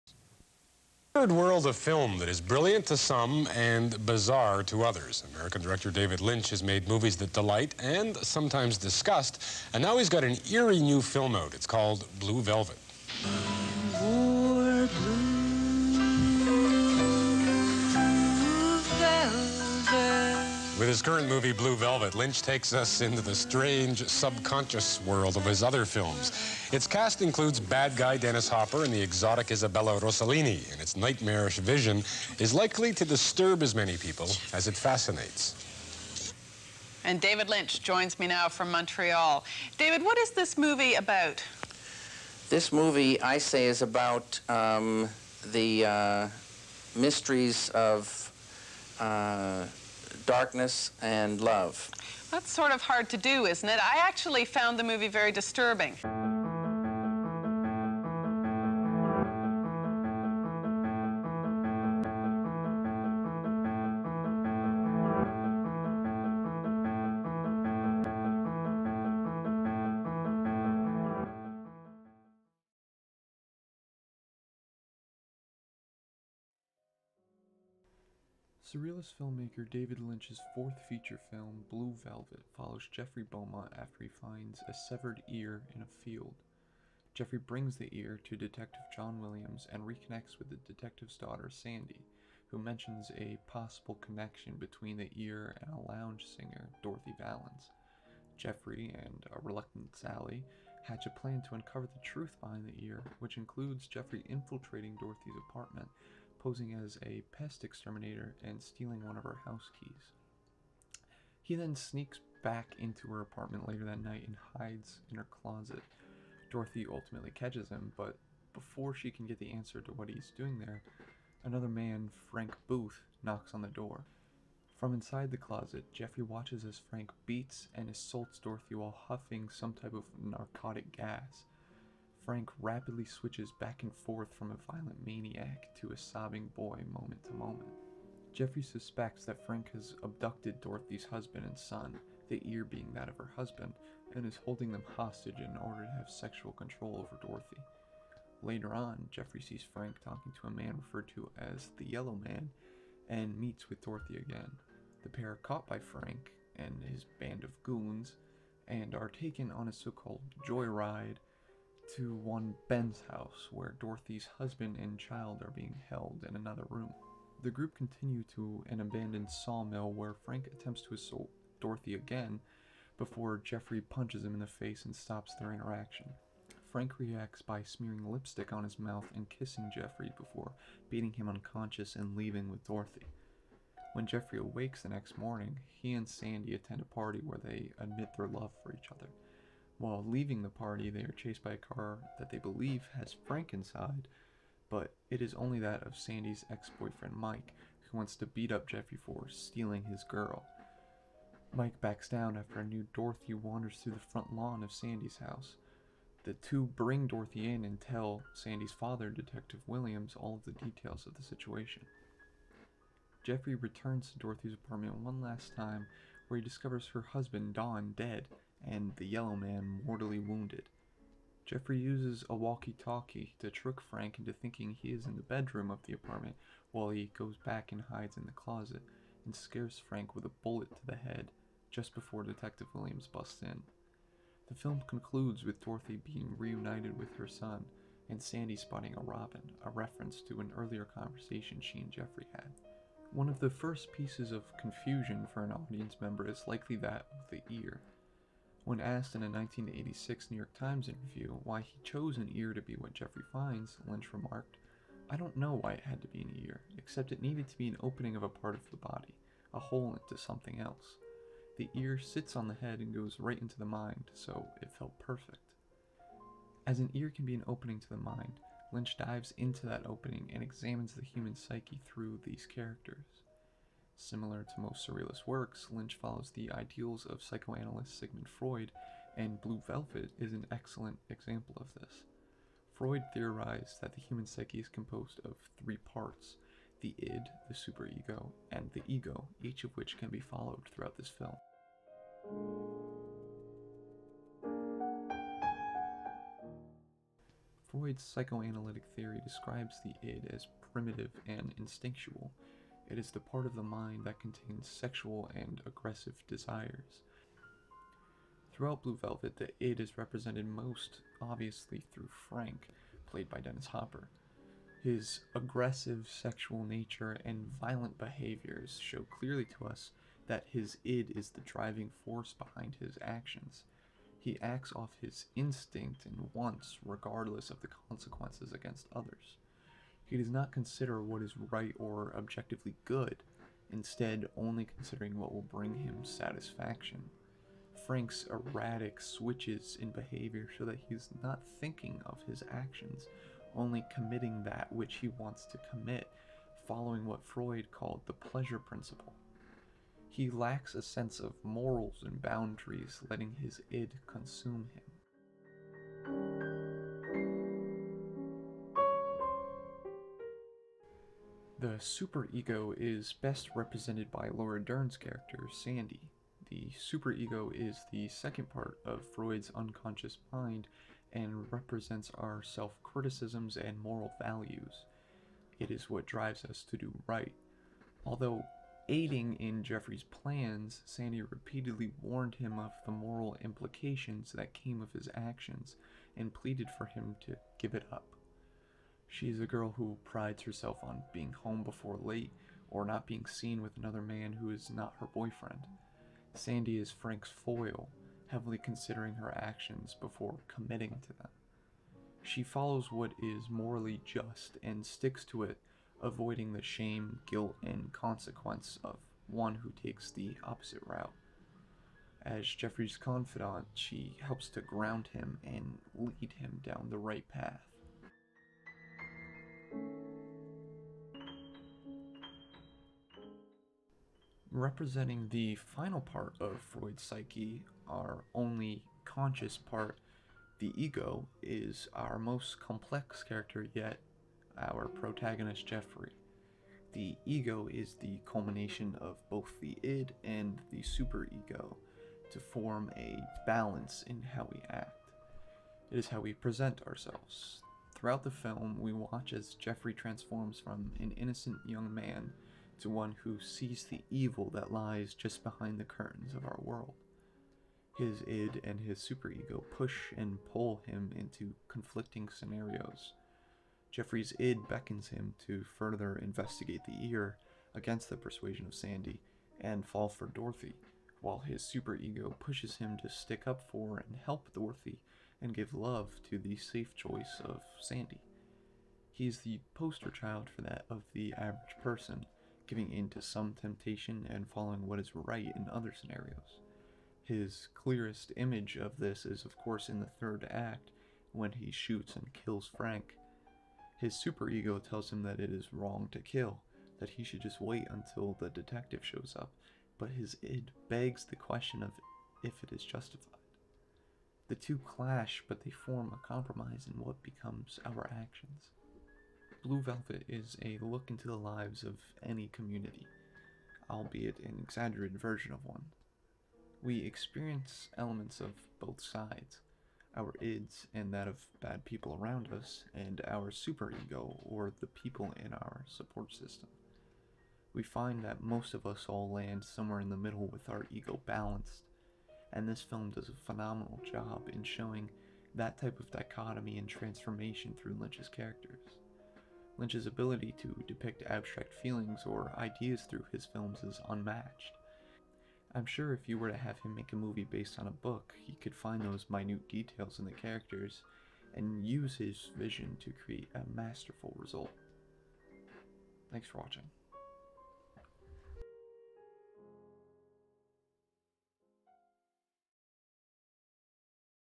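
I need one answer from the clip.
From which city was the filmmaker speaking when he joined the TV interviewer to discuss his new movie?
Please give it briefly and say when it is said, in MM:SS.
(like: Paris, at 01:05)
Montreal, at 00:38.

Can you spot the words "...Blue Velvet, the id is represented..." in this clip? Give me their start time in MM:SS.
05:08.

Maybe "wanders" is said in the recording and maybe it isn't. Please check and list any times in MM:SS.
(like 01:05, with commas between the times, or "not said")
03:23.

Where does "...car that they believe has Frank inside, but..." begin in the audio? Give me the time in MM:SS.
03:11.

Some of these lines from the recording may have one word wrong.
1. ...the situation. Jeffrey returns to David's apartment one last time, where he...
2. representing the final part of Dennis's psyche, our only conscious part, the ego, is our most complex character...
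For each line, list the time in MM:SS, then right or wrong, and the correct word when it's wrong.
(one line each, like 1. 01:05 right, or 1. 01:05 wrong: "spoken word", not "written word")
1. 03:31 wrong: "Dorothy", not "David"
2. 07:04 wrong: "Freud", not "Dennis".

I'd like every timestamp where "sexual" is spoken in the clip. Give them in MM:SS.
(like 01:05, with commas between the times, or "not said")
02:26, 05:04, 05:16.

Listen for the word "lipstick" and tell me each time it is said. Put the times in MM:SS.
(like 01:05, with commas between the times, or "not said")
02:58.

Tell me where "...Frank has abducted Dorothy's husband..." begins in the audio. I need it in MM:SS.
02:19.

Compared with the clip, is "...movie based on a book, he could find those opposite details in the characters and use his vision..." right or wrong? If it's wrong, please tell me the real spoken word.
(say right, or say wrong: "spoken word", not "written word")
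wrong: "minute", not "opposite".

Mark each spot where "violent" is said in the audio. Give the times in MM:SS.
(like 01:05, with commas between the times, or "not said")
02:14, 05:17.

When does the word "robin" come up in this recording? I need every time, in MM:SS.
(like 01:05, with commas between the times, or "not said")
03:59.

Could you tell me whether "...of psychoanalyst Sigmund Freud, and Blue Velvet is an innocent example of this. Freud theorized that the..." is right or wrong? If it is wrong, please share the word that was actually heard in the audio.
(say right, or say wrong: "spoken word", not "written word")
wrong: "excellent", not "innocent".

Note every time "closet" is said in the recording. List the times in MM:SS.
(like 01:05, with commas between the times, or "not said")
01:55, 02:05, 03:48.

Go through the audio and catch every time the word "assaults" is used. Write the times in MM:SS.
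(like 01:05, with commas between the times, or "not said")
02:07, 02:50.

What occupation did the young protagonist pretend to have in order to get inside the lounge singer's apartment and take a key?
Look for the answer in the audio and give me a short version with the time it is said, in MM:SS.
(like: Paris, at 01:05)
pest exterminator, at 01:47.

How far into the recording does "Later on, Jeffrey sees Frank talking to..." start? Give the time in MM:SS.
02:28.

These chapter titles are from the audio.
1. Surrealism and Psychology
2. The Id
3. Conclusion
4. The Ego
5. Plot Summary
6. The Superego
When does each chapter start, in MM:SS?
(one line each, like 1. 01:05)
1. 04:02
2. 04:51
3. 08:29
4. 06:58
5. 01:17
6. 05:55.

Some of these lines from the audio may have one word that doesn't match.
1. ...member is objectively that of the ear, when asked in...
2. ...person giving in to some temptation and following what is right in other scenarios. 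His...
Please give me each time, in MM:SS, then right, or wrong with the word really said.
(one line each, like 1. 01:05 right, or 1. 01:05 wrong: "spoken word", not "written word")
1. 04:06 wrong: "likely", not "objectively"
2. 08:01 right.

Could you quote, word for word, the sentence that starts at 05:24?
He acts off his instinct and wants, regardless of the consequences against others.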